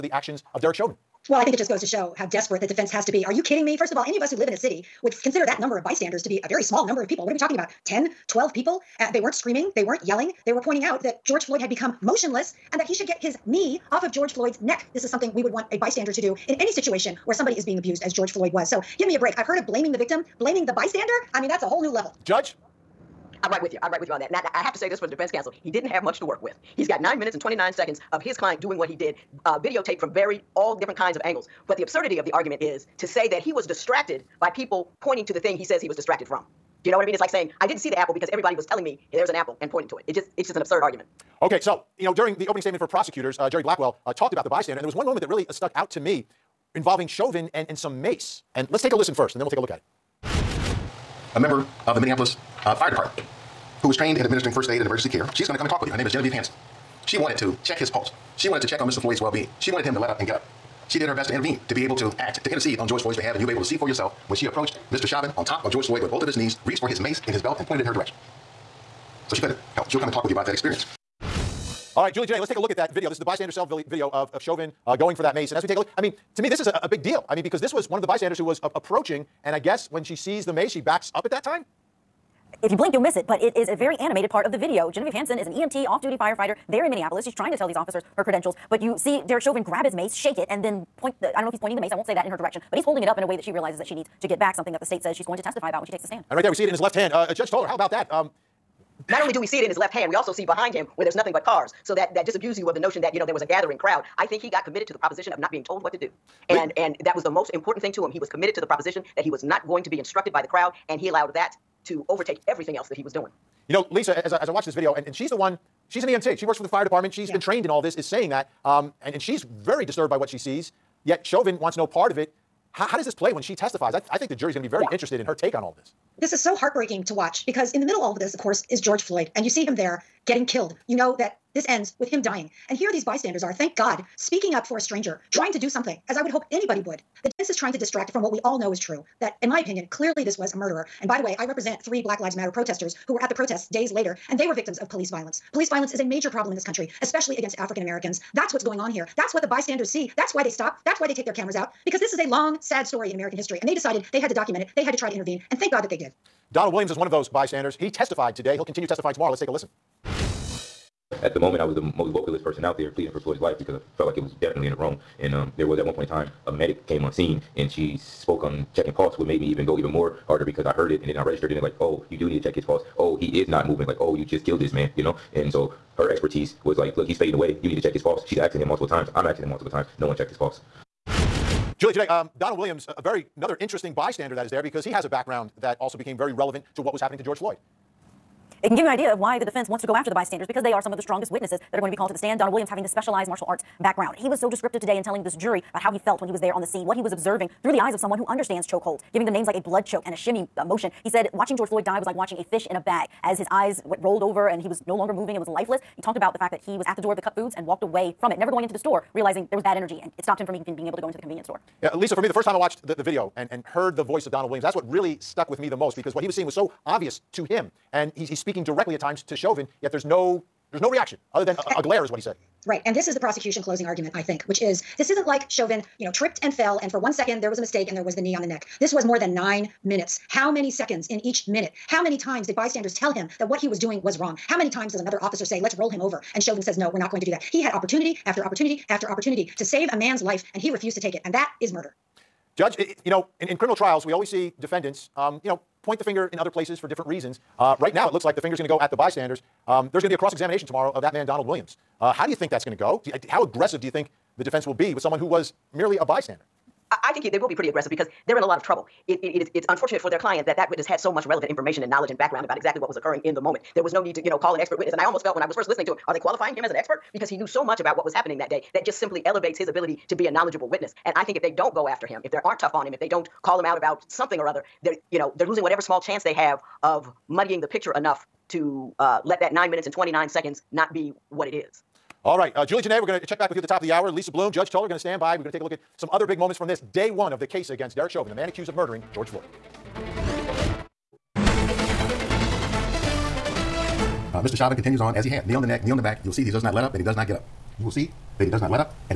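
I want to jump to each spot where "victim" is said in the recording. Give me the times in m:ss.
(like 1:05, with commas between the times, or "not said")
0:19, 2:24.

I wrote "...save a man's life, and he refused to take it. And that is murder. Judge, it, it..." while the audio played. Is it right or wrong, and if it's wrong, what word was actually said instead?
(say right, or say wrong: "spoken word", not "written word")
right.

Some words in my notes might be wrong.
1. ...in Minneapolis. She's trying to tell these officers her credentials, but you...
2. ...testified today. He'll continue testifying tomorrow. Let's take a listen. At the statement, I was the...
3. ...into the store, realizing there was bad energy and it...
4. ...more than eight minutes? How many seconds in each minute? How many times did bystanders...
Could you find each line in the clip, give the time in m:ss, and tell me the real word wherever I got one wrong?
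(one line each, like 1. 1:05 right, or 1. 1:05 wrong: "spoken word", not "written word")
1. 1:26 right
2. 2:37 wrong: "moment", not "statement"
3. 3:28 right
4. 3:49 wrong: "nine", not "eight".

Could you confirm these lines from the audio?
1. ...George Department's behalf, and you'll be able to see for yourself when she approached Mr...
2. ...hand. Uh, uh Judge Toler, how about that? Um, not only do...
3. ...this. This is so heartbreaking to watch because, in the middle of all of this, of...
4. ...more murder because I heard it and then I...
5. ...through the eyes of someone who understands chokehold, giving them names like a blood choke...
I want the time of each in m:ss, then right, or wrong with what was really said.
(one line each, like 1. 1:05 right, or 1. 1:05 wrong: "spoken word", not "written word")
1. 1:02 wrong: "Floyd", not "Department"
2. 1:36 right
3. 2:05 right
4. 2:49 wrong: "harder", not "murder"
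5. 3:17 right.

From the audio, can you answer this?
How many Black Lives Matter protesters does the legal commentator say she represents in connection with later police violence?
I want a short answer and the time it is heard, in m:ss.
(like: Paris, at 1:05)
3, at 2:21.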